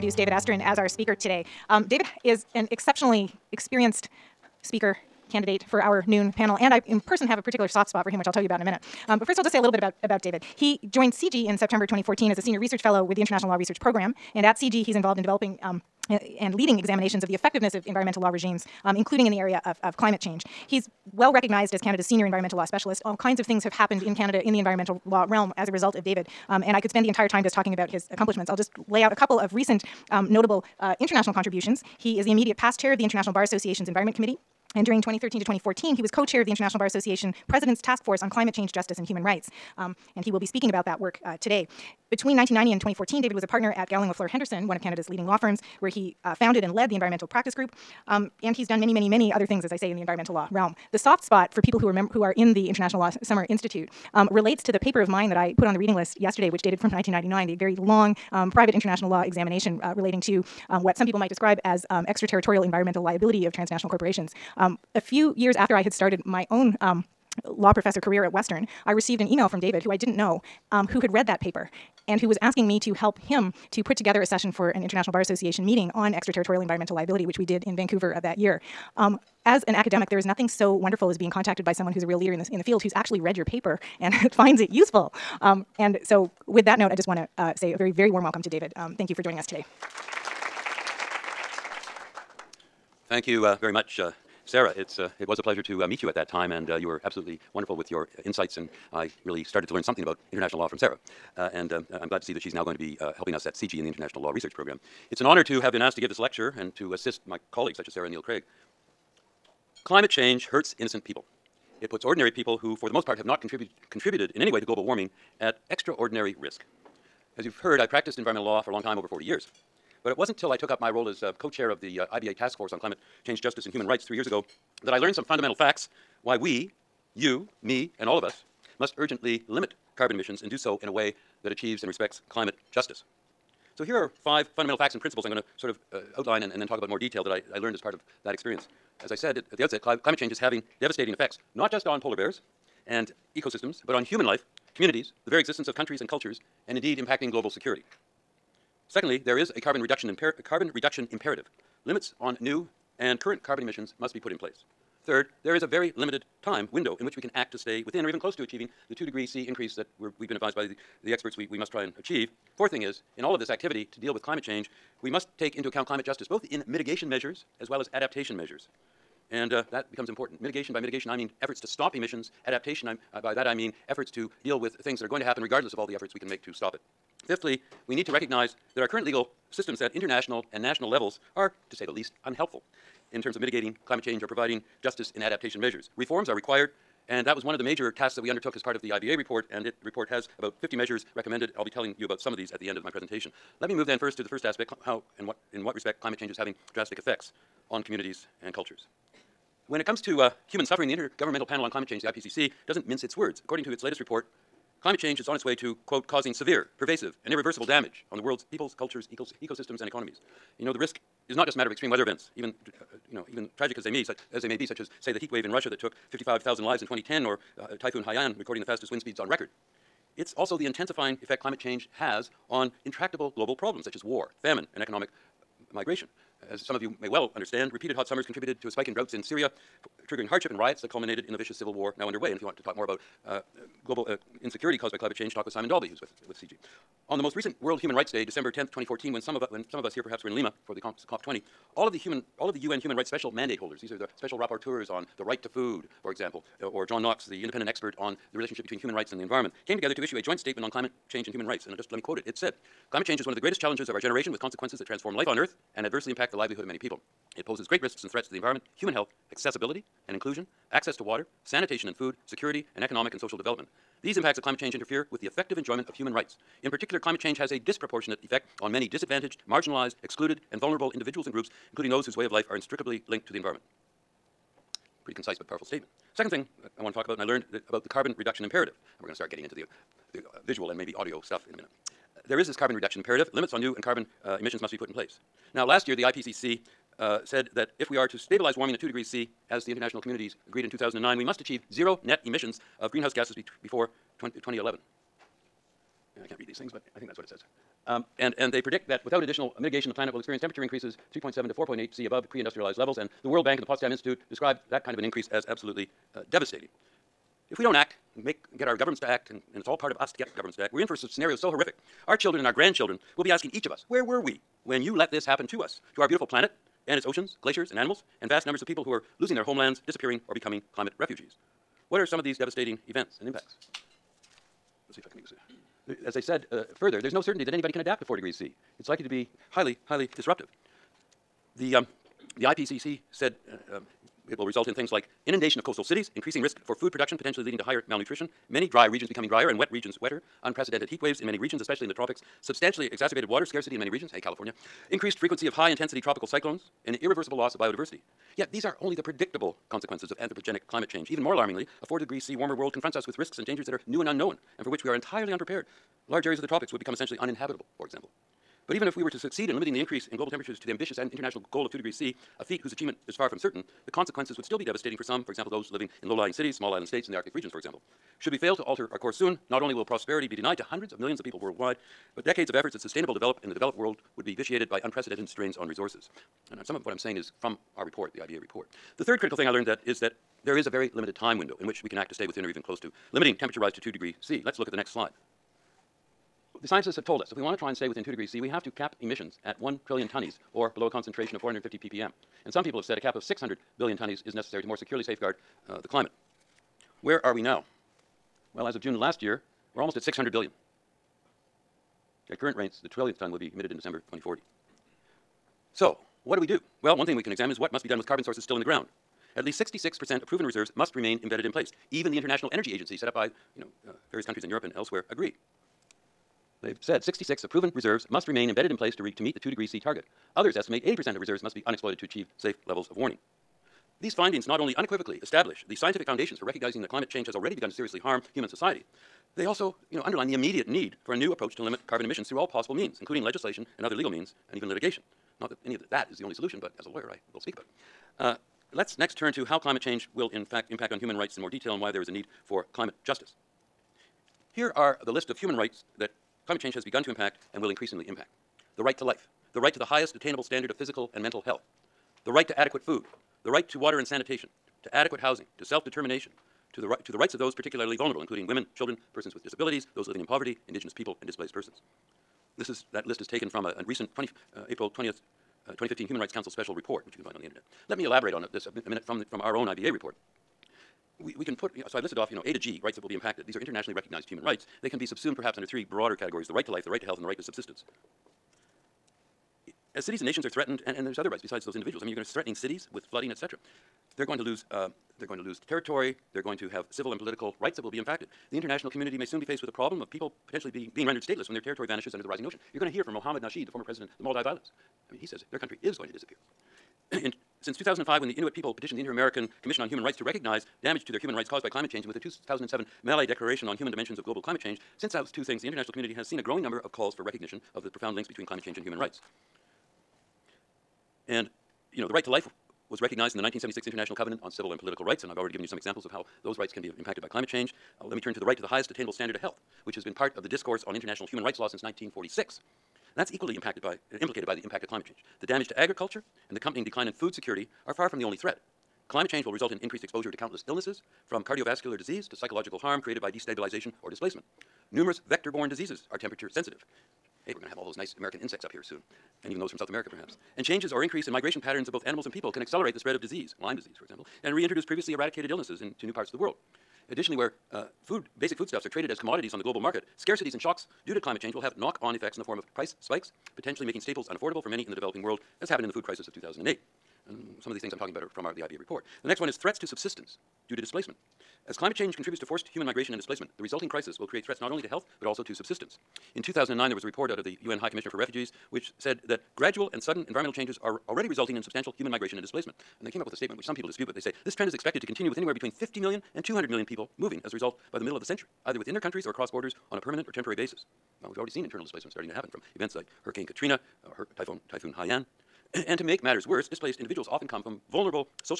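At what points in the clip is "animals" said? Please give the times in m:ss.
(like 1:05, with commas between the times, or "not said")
5:17, 9:02.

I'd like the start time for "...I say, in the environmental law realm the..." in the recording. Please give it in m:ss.
0:49.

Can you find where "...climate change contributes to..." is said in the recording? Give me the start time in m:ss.
9:21.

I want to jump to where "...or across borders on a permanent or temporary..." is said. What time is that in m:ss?
9:39.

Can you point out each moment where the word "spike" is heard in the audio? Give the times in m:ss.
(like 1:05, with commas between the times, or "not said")
3:48, 9:13.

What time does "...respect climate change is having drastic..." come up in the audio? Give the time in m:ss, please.
3:15.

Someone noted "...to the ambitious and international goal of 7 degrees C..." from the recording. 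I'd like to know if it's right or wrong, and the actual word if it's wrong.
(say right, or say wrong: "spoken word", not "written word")
wrong: "2", not "7".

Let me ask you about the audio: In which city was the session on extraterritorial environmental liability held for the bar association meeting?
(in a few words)
Vancouver.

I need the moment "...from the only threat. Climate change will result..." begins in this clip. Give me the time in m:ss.
8:48.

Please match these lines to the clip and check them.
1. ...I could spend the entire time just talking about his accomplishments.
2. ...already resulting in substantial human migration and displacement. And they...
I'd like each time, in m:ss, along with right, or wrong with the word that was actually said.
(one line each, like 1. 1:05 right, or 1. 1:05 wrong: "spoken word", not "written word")
1. 0:26 right
2. 9:31 right.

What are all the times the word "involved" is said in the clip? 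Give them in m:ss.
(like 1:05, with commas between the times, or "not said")
0:14.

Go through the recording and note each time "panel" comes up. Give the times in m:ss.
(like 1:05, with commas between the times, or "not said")
0:06, 3:21.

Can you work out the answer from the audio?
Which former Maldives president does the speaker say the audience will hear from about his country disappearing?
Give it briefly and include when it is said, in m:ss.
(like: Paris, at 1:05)
Mohammed Nasheed, at 8:13.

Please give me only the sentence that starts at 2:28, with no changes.
Secondly, there is a carbon reduction, carbon reduction imperative.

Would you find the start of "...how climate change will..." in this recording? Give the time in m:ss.
7:19.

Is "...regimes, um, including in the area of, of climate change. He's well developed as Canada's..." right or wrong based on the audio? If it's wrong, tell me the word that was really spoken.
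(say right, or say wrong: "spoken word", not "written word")
wrong: "recognized", not "developed".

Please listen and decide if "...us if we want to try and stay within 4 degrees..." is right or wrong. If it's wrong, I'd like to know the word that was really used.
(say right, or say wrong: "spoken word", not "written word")
wrong: "2", not "4".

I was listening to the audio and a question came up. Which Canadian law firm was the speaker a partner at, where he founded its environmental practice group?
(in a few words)
Gowling LaFleur Henderson.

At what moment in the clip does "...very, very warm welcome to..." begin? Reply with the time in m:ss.
1:27.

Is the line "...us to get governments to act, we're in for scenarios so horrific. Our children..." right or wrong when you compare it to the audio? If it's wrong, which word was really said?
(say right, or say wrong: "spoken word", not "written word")
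right.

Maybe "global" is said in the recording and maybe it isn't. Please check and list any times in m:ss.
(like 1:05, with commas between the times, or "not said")
1:54, 2:27, 3:43, 3:53, 6:00, 8:24, 9:09.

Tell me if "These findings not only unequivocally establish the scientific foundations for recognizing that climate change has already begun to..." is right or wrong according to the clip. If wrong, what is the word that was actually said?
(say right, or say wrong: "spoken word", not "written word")
right.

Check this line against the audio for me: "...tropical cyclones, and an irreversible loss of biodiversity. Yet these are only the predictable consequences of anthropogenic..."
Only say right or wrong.
right.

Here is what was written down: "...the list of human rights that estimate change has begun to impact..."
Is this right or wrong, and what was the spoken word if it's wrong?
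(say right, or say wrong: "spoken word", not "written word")
wrong: "climate", not "estimate".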